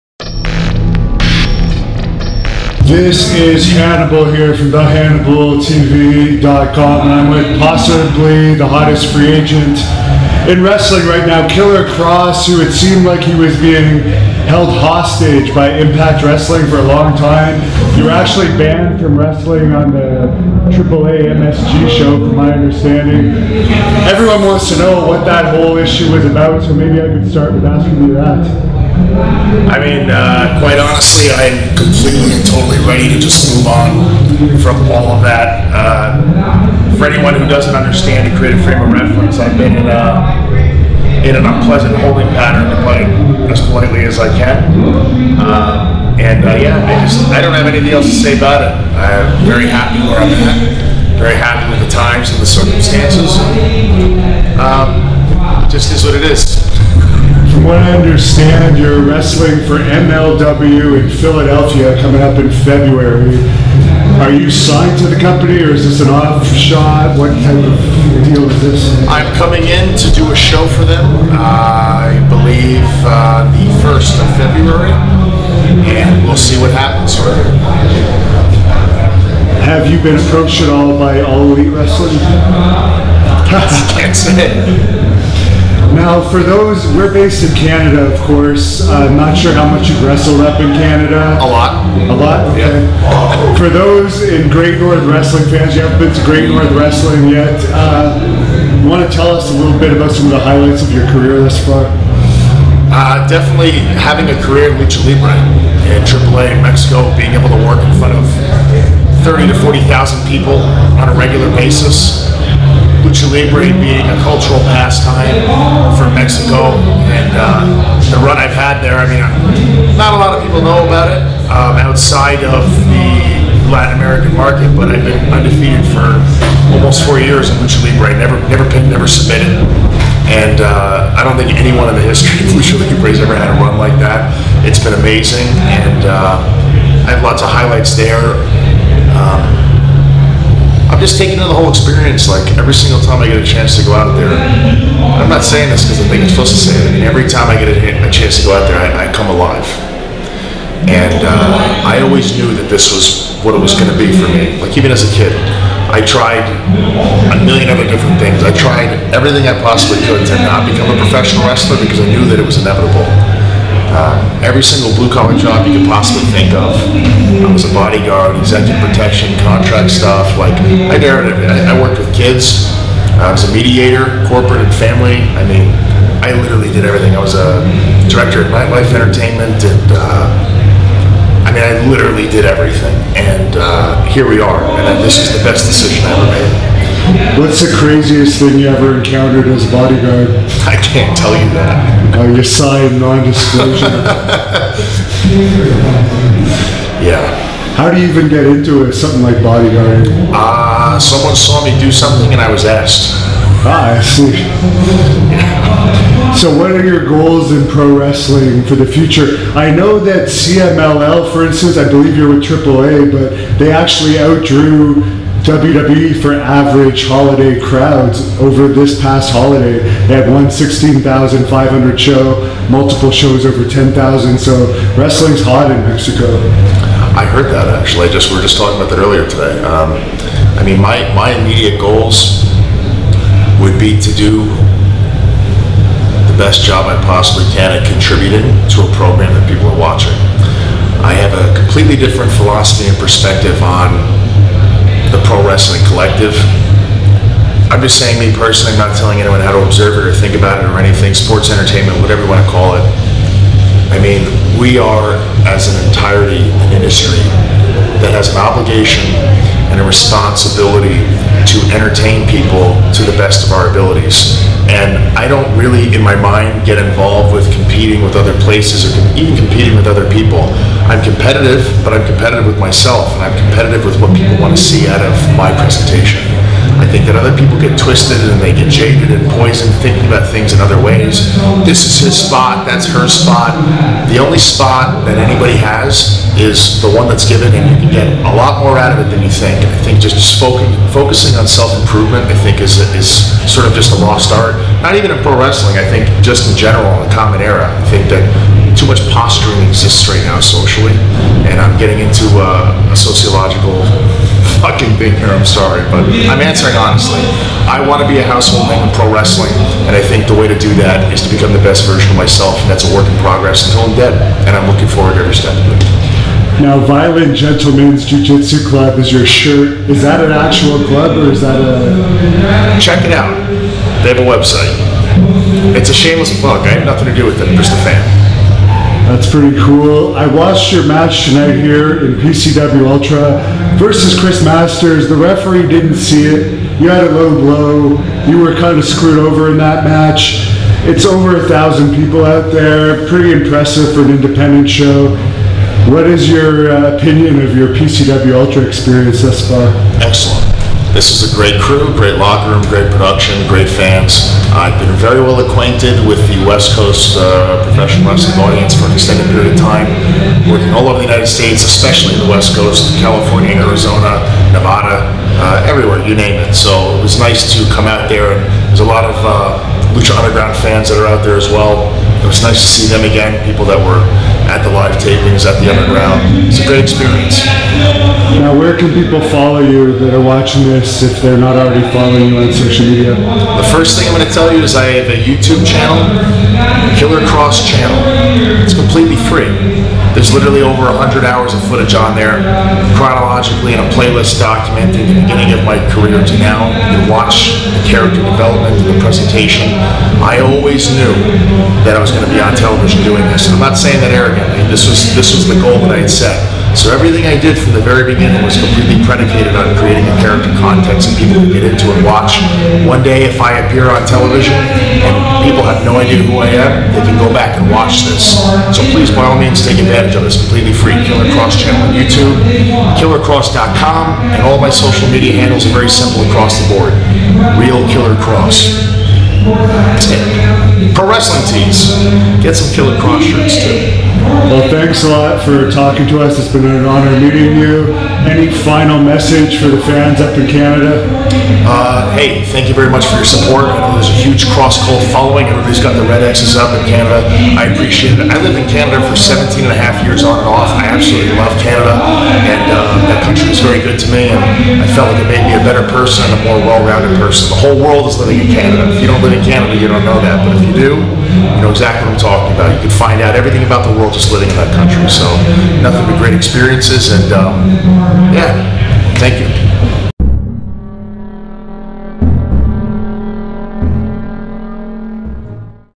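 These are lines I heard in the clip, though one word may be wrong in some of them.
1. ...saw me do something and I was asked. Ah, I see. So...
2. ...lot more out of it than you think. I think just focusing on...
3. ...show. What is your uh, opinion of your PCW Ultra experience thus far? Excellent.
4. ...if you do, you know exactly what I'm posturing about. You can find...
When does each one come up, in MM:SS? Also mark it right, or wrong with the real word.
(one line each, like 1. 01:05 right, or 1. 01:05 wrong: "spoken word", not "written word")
1. 03:21 right
2. 04:48 right
3. 05:44 right
4. 07:40 wrong: "talking", not "posturing".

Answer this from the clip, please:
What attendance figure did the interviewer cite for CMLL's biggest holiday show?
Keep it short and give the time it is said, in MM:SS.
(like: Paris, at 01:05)
16,500, at 03:40.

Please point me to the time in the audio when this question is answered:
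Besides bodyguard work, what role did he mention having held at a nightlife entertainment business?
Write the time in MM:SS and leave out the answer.
02:58.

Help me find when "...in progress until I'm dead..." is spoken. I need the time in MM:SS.
05:13.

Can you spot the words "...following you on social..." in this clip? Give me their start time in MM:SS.
06:21.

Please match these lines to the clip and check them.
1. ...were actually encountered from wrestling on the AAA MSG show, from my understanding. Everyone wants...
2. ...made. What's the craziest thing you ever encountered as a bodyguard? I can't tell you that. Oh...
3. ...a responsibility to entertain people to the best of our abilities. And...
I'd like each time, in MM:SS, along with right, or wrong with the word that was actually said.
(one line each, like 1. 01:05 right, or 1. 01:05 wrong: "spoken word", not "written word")
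1. 00:18 wrong: "banned", not "encountered"
2. 03:06 right
3. 04:19 right.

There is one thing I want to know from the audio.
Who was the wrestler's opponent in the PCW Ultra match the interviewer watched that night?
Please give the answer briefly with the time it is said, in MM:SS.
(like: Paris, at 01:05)
Chris Masters, at 05:34.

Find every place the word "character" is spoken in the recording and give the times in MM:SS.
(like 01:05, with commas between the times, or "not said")
06:37, 06:50.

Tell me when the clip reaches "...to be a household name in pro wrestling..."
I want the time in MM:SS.
05:08.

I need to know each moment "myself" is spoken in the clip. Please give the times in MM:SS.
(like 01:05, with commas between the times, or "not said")
04:32, 05:12.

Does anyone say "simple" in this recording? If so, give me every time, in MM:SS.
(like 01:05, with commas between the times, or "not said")
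07:05.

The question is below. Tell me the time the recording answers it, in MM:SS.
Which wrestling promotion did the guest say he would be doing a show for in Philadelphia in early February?
00:59.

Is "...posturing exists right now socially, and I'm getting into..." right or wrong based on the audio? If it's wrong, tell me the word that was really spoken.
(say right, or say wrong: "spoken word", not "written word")
right.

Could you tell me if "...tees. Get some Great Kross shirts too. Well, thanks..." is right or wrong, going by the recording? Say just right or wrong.
wrong.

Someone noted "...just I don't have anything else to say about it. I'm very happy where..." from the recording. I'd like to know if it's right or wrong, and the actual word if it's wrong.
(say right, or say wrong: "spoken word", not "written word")
right.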